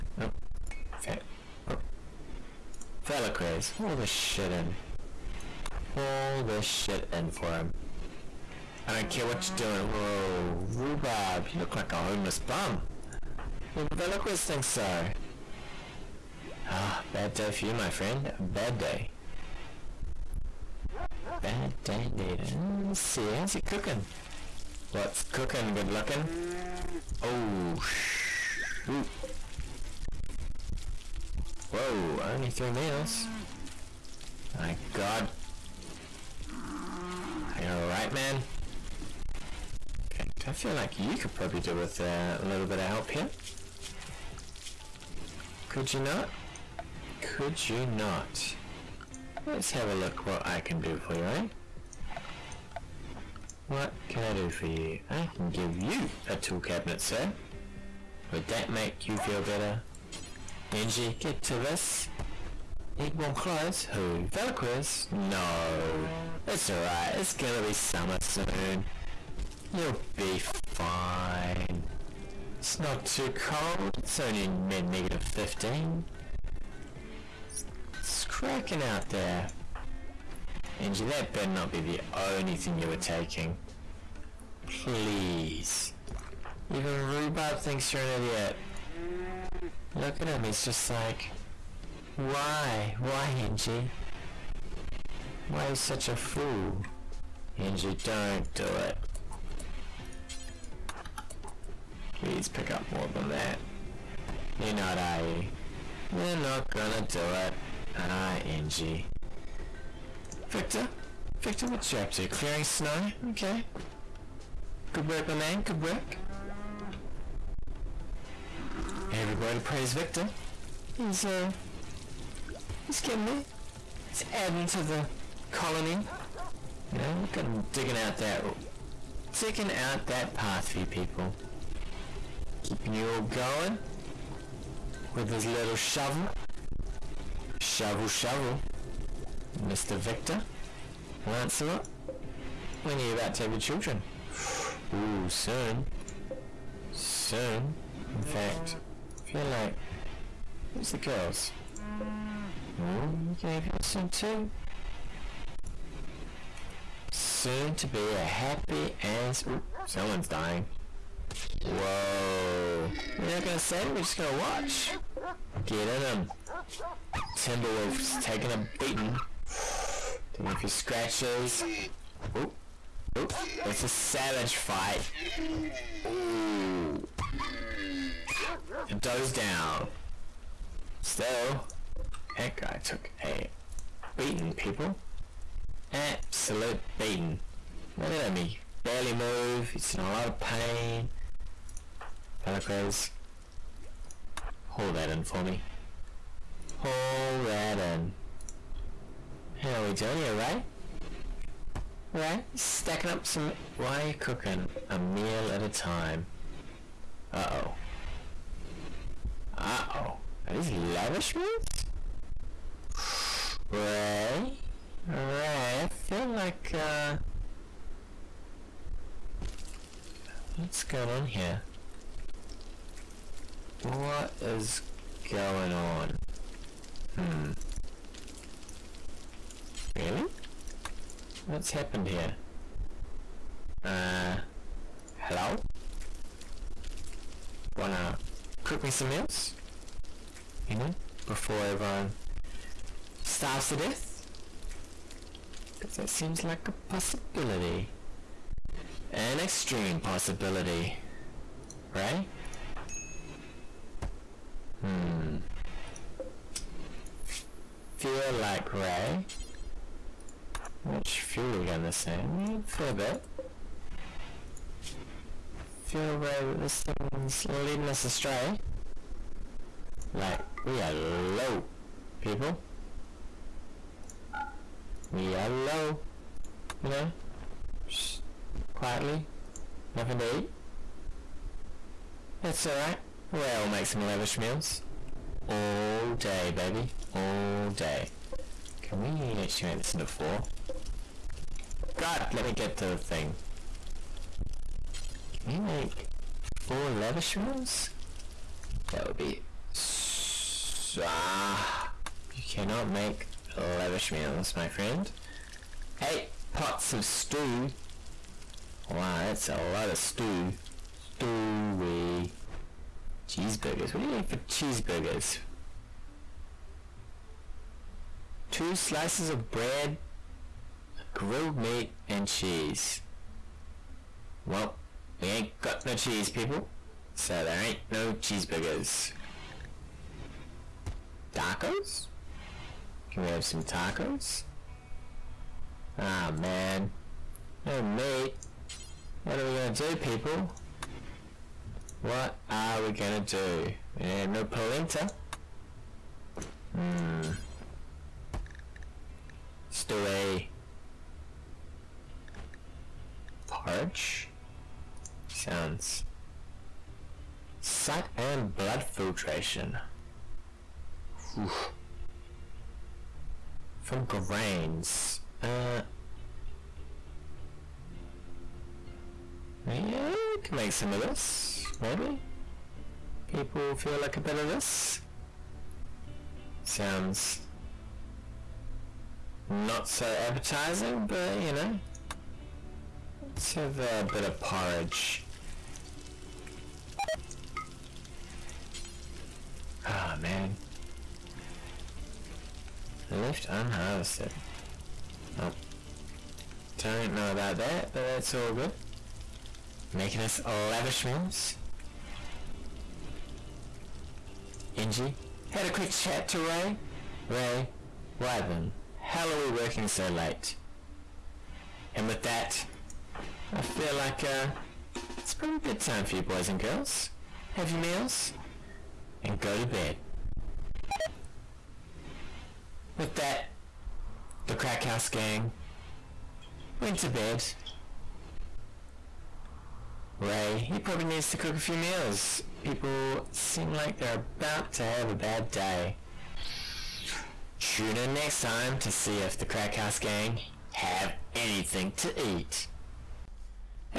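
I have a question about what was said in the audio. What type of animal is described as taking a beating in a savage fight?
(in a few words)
Timberwolf.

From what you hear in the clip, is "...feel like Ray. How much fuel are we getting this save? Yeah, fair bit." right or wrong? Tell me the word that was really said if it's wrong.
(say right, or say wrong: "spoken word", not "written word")
right.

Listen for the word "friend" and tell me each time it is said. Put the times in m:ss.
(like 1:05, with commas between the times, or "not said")
0:17, 5:04.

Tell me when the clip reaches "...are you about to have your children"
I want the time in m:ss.
2:22.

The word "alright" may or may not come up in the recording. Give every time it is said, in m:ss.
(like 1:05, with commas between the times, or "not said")
0:37, 1:06, 4:42.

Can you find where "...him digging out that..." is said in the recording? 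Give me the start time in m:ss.
2:07.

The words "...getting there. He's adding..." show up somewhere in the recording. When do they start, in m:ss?
2:03.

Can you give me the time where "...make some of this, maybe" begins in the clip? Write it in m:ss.
6:10.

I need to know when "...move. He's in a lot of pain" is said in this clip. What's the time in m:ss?
3:09.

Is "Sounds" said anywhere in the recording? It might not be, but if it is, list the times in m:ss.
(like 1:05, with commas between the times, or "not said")
5:55, 6:16.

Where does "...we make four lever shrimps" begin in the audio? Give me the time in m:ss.
4:55.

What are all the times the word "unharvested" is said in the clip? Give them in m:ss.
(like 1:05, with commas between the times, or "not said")
6:33.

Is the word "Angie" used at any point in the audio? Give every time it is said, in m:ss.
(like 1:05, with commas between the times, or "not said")
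1:00, 1:20, 1:33, 1:37, 1:48, 6:44.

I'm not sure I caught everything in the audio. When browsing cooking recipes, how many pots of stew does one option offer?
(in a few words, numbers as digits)
8.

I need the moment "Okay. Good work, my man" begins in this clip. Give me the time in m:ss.
1:53.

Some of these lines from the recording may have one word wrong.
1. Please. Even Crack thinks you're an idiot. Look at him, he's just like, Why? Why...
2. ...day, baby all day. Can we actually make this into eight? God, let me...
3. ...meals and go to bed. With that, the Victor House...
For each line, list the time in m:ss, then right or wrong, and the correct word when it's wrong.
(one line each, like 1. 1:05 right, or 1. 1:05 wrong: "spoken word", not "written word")
1. 1:24 wrong: "Rhubarb", not "Crack"
2. 4:46 wrong: "four", not "eight"
3. 6:57 wrong: "Crack", not "Victor".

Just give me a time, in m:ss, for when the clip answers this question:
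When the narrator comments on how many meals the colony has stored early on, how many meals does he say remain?
0:32.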